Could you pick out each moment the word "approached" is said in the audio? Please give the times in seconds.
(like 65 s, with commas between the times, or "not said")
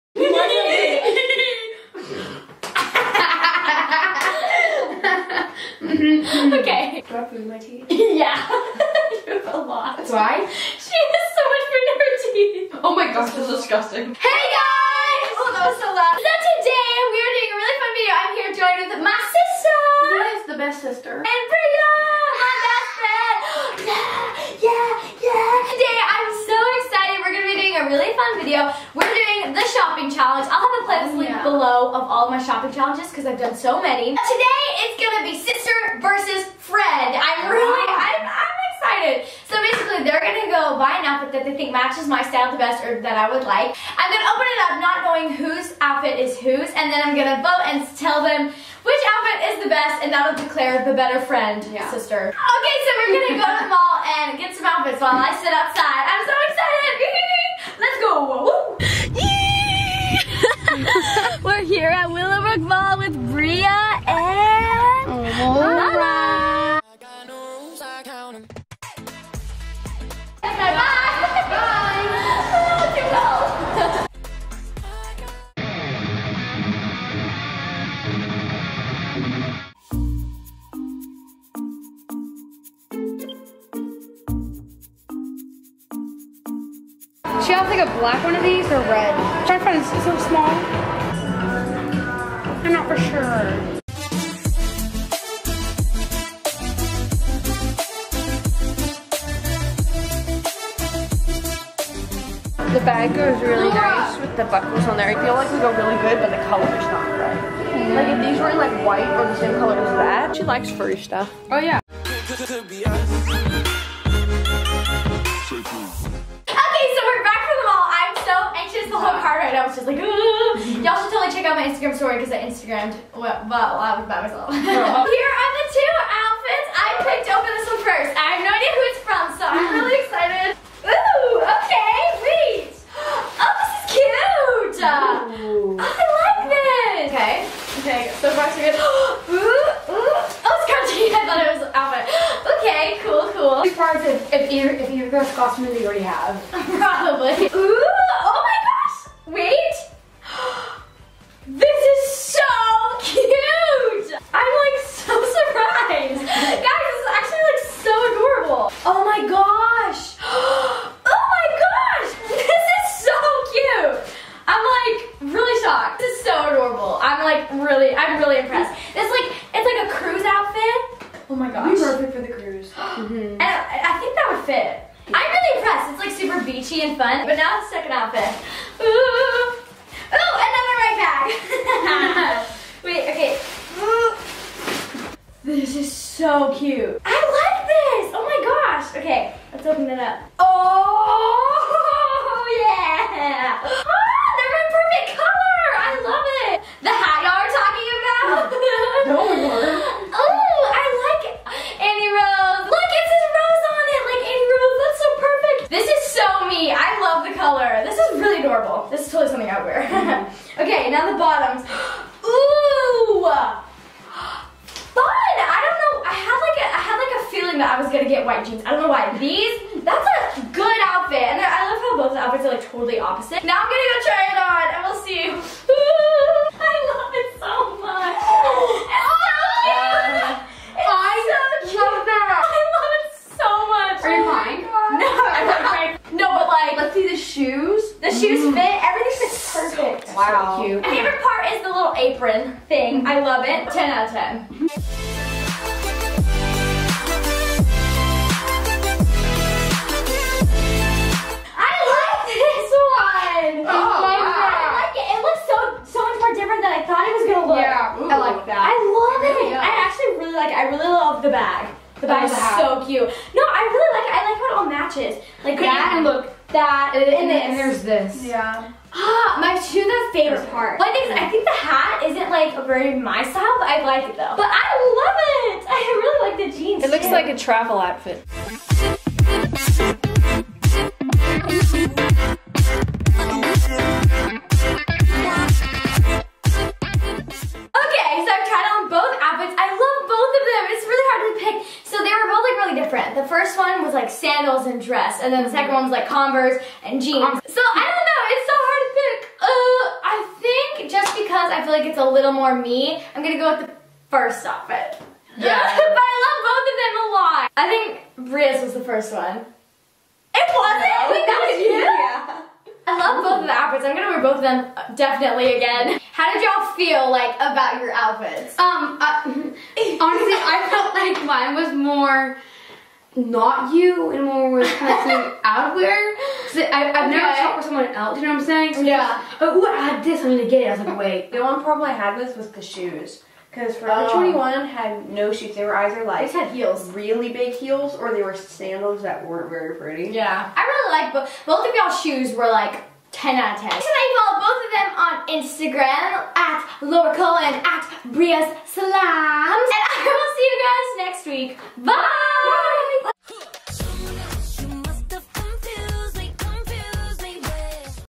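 not said.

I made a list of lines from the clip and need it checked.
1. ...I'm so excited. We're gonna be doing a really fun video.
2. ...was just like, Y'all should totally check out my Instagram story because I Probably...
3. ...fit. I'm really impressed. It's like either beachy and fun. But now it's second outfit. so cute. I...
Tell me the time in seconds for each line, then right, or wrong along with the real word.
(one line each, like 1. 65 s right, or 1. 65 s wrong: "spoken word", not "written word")
1. 26 s right
2. 119 s wrong: "Instagrammed", not "Probably"
3. 174 s wrong: "super", not "either".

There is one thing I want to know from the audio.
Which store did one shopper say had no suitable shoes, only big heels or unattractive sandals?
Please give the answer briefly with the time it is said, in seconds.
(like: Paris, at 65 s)
Forever 21, at 333 s.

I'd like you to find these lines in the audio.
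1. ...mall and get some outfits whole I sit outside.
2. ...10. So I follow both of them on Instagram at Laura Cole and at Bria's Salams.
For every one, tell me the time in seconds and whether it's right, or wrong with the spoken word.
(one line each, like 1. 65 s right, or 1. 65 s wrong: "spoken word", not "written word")
1. 53 s wrong: "while", not "whole"
2. 343 s right.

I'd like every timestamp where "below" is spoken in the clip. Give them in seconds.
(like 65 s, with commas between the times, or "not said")
31 s.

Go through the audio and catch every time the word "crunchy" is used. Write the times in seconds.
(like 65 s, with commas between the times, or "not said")
140 s.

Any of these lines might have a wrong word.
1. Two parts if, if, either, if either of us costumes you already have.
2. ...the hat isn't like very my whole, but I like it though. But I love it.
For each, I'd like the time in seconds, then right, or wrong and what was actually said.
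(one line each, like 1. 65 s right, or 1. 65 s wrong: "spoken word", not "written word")
1. 143 s right
2. 271 s wrong: "style", not "whole".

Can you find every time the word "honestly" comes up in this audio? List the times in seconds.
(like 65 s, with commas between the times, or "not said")
319 s.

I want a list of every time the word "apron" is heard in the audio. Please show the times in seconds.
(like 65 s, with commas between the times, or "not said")
241 s.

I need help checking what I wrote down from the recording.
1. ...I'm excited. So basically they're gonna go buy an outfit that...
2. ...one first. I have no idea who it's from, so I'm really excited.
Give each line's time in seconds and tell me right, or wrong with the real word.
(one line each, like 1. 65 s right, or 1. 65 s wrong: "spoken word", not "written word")
1. 38 s right
2. 127 s right.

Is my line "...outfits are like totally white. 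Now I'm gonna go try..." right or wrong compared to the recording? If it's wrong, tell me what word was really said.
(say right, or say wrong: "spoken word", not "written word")
wrong: "opposite", not "white".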